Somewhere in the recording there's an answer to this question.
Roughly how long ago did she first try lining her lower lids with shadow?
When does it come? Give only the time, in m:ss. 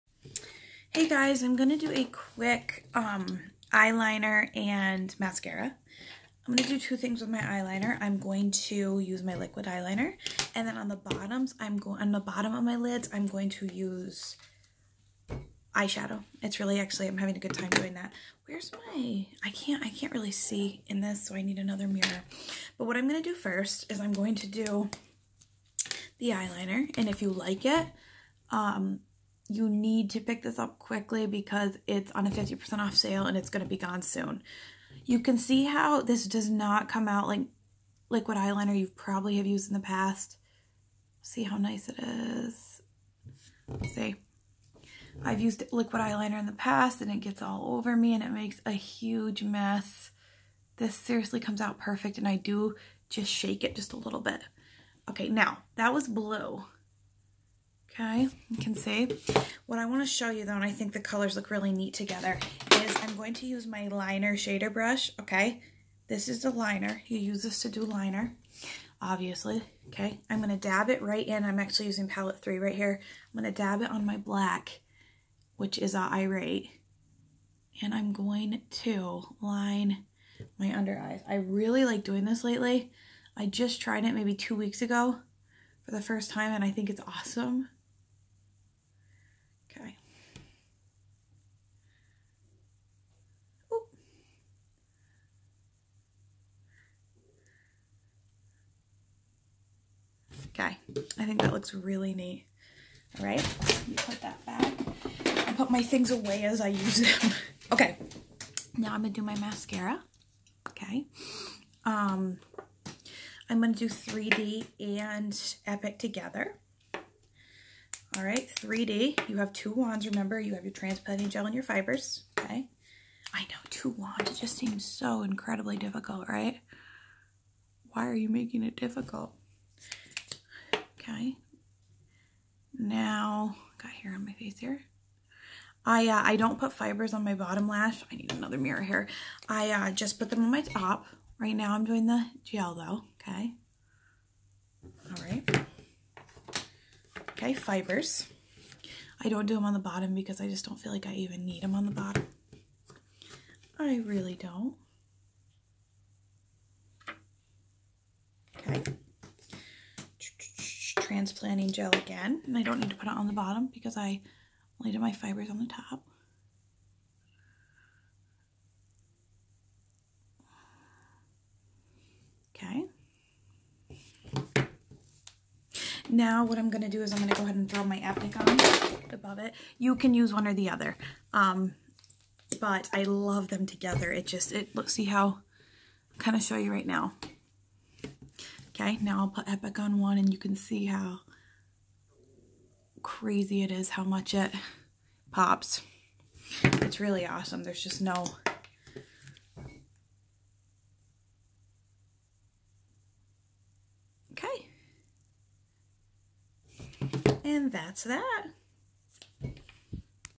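1:24.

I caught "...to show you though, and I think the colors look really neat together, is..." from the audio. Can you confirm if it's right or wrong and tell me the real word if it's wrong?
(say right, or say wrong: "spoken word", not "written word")
right.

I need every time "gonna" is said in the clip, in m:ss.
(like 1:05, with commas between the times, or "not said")
1:49, 1:53.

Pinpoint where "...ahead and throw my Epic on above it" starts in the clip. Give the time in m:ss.
2:57.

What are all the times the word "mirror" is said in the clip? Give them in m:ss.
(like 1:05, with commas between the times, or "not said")
0:21, 2:18.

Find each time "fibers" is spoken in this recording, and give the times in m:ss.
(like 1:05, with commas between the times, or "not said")
2:01, 2:16, 2:27, 2:45.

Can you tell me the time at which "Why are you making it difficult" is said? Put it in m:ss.
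2:07.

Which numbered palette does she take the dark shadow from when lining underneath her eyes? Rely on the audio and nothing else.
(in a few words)
palette 3.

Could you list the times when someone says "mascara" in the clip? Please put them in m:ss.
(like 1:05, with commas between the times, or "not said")
0:05, 1:49.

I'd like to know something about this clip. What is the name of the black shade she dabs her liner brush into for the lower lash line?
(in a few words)
irate.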